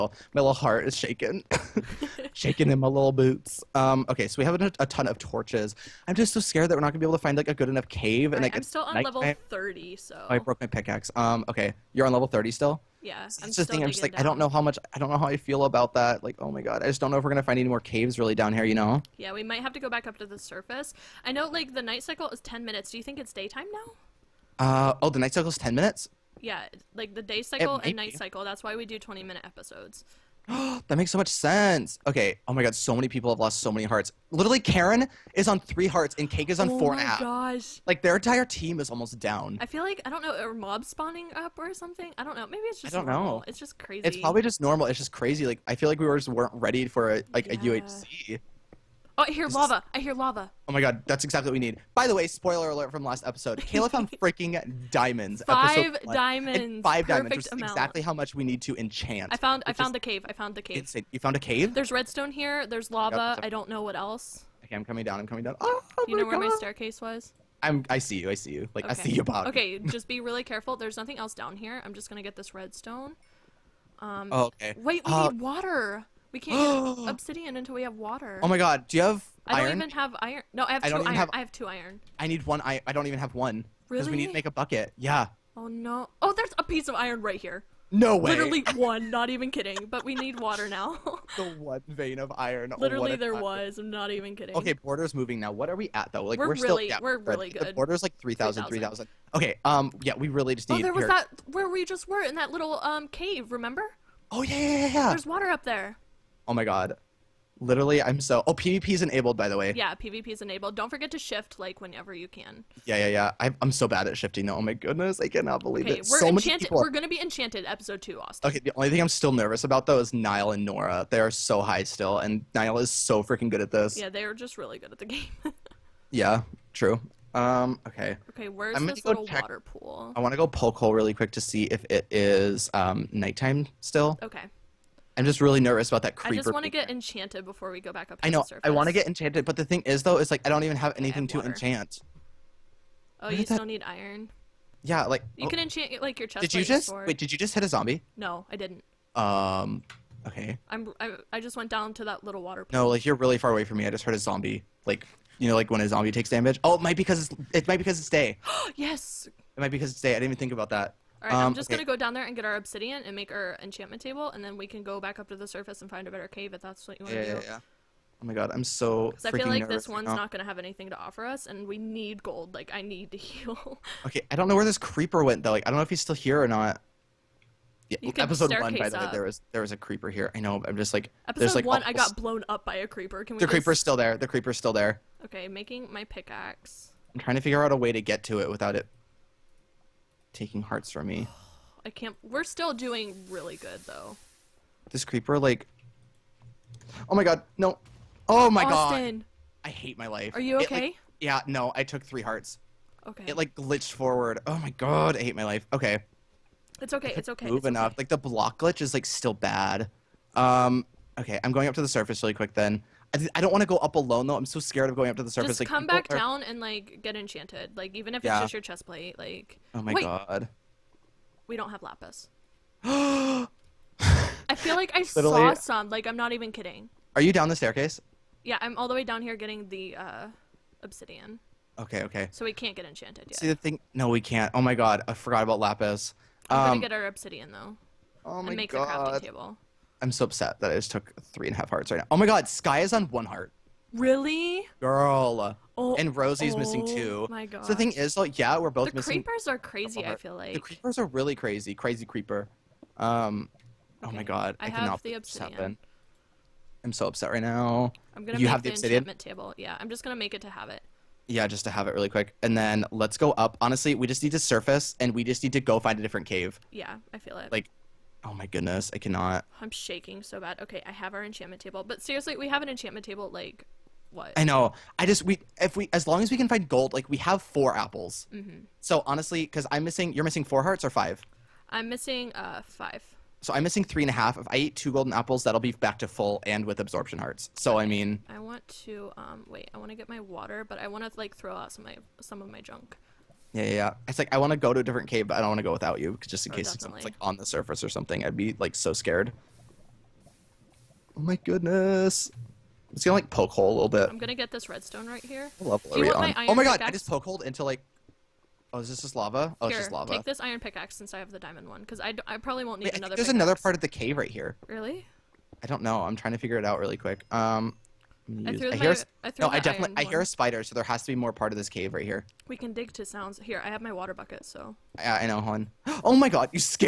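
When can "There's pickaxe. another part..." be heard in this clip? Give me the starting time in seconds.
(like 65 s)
313 s.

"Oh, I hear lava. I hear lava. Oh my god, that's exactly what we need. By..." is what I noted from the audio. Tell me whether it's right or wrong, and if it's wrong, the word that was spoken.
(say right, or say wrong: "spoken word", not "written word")
right.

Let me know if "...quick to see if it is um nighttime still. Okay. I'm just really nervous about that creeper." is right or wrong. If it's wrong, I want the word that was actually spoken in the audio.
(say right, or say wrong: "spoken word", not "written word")
right.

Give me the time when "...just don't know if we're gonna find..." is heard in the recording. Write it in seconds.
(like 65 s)
16 s.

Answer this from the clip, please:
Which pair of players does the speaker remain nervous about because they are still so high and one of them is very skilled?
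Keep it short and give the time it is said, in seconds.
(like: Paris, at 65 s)
Niall and Nora, at 120 s.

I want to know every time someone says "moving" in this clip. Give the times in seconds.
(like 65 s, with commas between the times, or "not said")
95 s, 207 s.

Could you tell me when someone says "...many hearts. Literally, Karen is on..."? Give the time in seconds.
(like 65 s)
33 s.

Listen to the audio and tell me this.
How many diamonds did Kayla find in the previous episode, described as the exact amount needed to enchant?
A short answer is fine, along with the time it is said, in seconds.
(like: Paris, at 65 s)
5, at 55 s.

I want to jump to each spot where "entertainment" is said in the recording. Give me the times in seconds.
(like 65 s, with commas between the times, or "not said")
not said.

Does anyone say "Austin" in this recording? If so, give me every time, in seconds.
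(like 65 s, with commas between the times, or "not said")
118 s, 198 s.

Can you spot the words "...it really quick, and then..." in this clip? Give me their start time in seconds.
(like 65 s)
261 s.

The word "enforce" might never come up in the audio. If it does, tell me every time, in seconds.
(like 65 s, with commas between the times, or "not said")
not said.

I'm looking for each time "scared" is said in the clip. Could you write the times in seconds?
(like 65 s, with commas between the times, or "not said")
6 s, 214 s, 298 s.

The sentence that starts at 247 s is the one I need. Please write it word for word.
So the thing is, like, yeah, we're both the missing.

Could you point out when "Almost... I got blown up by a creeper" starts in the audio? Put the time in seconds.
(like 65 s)
181 s.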